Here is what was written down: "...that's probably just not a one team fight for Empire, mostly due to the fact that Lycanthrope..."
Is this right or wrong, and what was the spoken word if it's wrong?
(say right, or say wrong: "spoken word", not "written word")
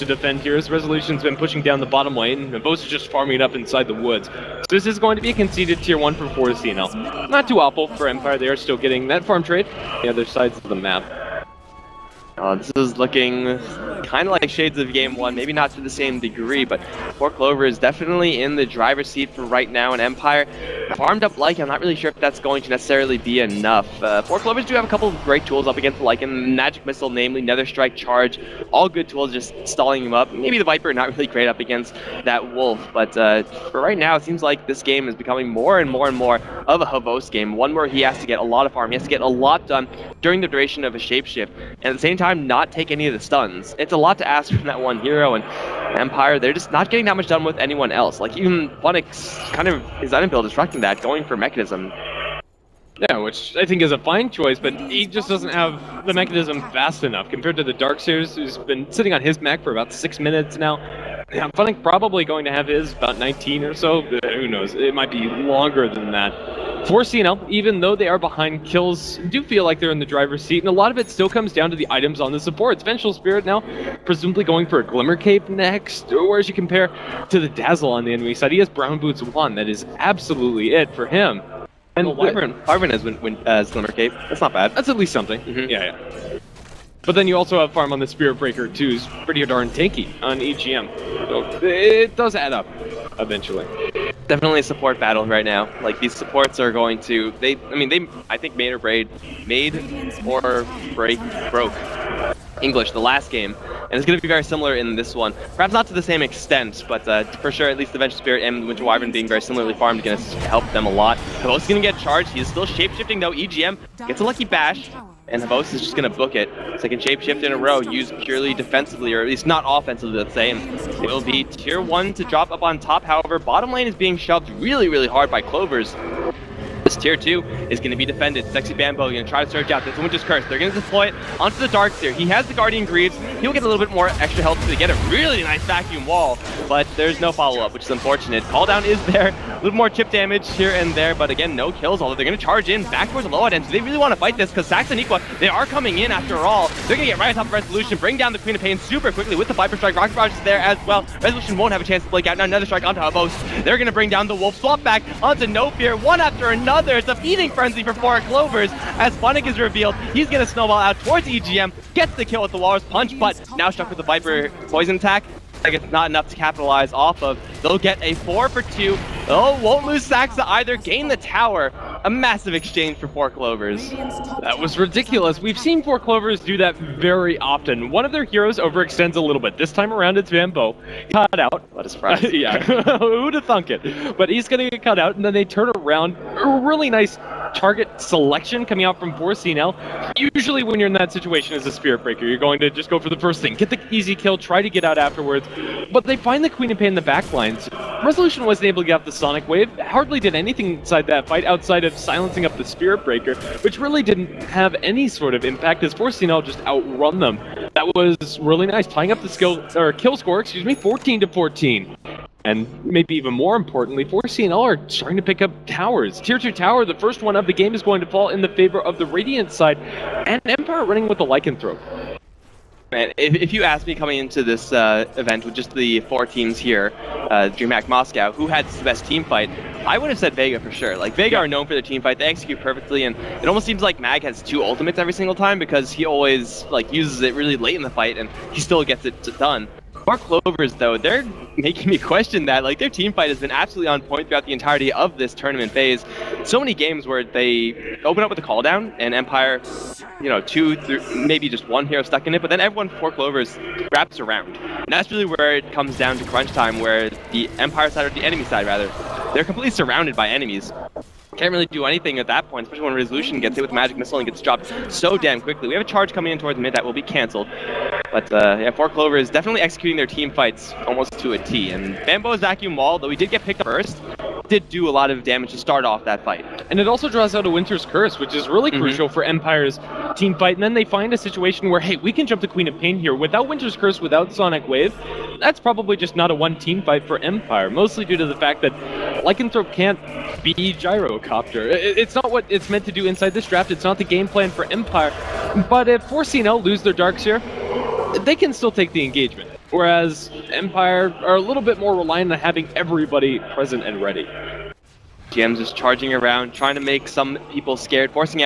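right.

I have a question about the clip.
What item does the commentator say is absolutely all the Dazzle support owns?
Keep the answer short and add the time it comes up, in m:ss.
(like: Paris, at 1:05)
Brown Boots, at 1:18.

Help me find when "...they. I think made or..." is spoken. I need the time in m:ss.
1:37.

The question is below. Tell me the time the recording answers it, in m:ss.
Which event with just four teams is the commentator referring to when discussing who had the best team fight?
3:47.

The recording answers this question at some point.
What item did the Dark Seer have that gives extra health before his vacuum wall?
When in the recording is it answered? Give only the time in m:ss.
2:12.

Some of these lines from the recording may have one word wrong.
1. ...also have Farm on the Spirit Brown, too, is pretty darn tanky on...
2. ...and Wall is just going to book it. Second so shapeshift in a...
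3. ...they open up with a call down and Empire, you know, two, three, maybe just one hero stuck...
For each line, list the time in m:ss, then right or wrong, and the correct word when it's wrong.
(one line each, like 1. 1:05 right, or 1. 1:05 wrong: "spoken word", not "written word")
1. 1:27 wrong: "Breaker", not "Brown"
2. 1:55 wrong: "Havos", not "Wall"
3. 4:07 right.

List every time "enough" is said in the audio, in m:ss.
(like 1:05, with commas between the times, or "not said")
0:23, 0:57, 2:46.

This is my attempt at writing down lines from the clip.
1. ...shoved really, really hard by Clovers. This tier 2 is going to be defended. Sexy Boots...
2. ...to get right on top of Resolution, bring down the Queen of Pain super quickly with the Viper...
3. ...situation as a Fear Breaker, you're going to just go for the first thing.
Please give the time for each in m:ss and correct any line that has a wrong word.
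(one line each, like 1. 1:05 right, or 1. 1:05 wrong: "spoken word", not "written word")
1. 2:04 wrong: "Bambo", not "Boots"
2. 2:27 right
3. 3:11 wrong: "Spirit", not "Fear".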